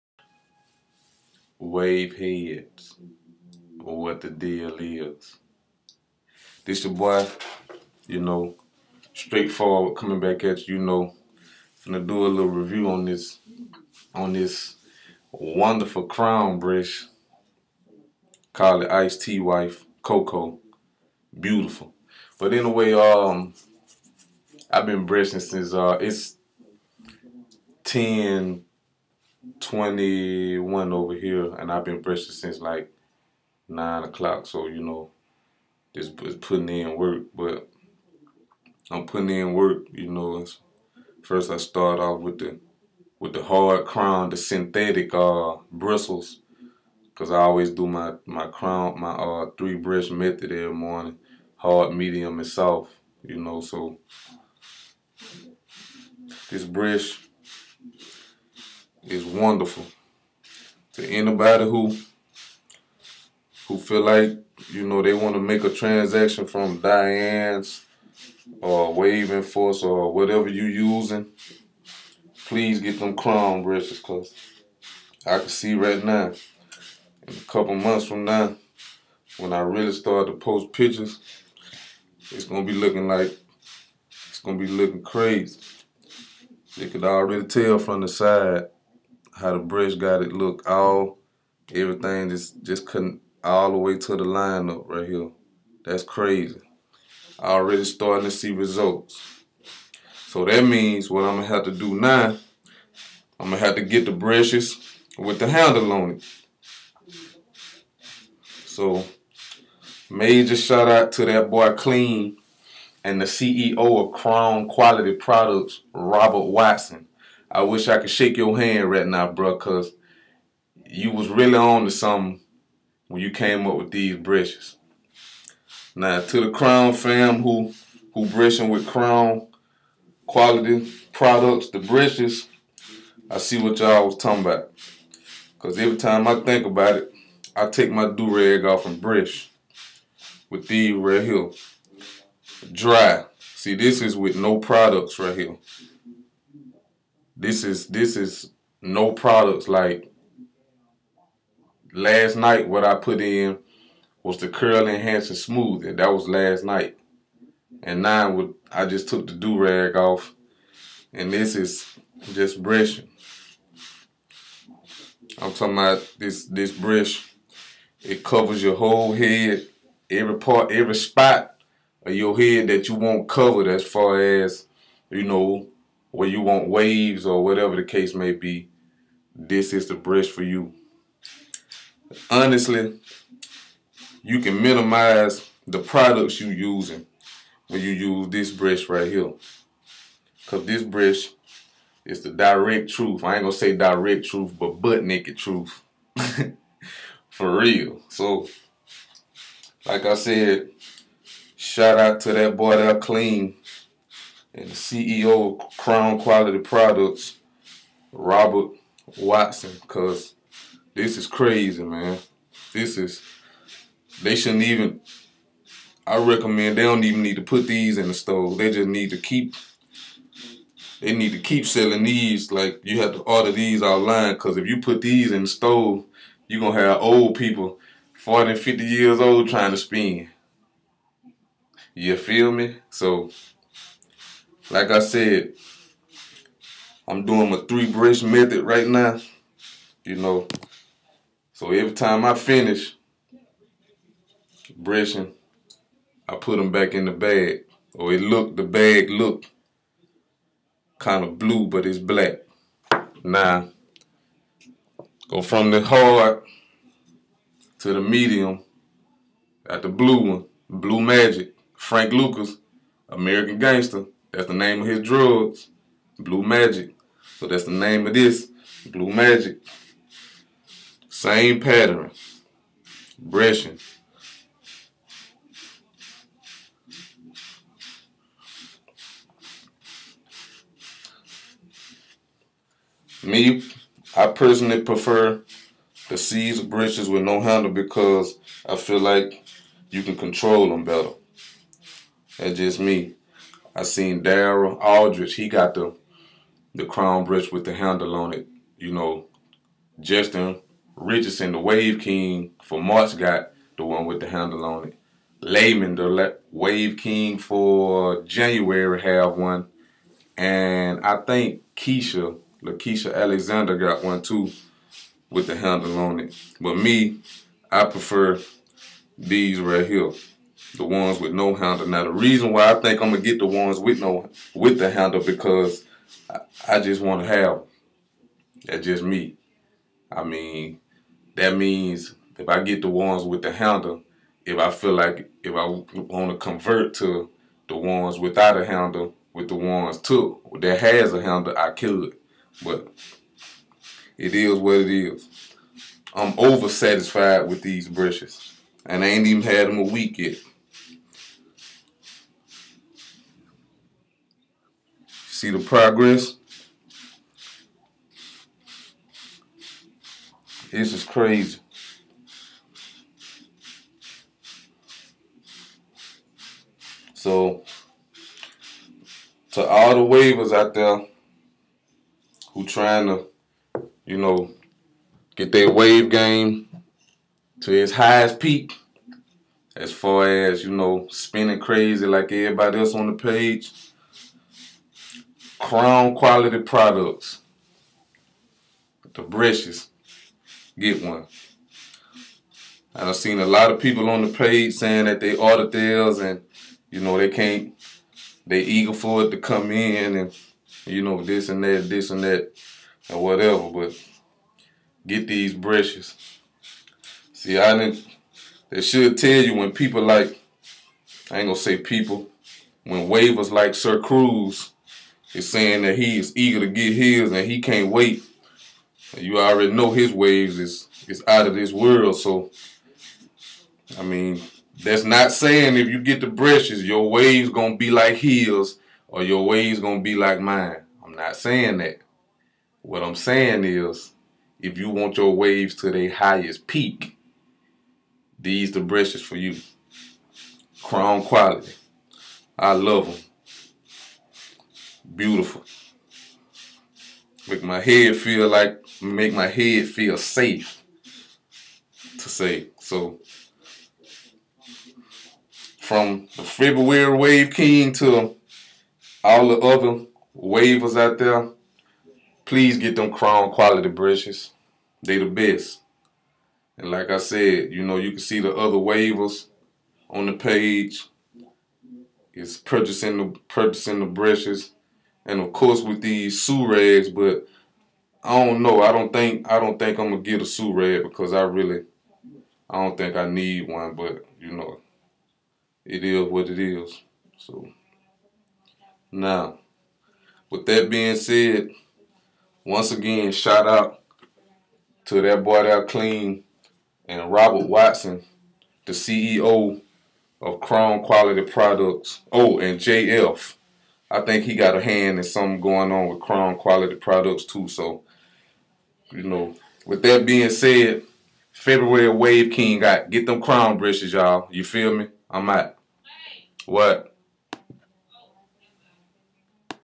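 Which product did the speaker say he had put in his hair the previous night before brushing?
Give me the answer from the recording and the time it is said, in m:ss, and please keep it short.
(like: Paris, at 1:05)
curl enhancer smooth, at 2:34.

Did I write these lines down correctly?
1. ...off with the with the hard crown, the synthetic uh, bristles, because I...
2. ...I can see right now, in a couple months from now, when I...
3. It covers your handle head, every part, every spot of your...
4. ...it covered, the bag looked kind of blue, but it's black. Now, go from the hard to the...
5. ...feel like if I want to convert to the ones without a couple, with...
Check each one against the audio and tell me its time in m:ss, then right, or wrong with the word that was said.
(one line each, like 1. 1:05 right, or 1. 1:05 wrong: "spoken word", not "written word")
1. 0:41 right
2. 1:15 right
3. 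2:48 wrong: "whole", not "handle"
4. 4:08 wrong: "looked", not "covered"
5. 5:34 wrong: "handle", not "couple".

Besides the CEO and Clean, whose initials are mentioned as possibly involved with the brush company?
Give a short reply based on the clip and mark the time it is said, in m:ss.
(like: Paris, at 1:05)
JF, at 8:22.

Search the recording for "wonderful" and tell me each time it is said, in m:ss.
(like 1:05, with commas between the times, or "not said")
0:15, 0:59.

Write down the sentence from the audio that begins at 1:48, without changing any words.
So major shout out to that boy Clean and the CEO of Crown Quality Products, Robert Watson.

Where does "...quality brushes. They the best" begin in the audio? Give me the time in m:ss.
7:43.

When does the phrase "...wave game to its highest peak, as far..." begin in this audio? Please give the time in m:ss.
6:15.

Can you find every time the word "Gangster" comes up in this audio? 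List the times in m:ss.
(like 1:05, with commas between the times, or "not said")
4:23.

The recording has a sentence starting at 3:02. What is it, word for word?
Honestly, you can minimize the products you using when you use this brush right here.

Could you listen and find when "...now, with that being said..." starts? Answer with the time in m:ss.
8:09.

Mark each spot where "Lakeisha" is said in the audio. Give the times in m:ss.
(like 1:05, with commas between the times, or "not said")
5:12.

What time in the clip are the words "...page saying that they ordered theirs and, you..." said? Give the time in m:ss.
6:34.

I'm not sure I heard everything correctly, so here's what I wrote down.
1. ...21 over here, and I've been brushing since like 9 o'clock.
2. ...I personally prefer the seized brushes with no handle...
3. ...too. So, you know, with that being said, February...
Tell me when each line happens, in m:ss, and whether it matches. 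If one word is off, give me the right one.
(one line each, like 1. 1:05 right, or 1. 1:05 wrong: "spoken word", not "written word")
1. 0:29 right
2. 4:44 right
3. 8:27 right.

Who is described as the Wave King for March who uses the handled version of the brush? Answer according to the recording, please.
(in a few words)
Justin Richardson.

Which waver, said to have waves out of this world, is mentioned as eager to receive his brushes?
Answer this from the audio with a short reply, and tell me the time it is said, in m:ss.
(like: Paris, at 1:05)
Sir Cruz, at 6:53.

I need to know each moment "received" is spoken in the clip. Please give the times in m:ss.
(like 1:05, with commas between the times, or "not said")
not said.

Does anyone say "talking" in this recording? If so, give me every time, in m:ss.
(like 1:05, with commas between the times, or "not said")
2:14, 2:45.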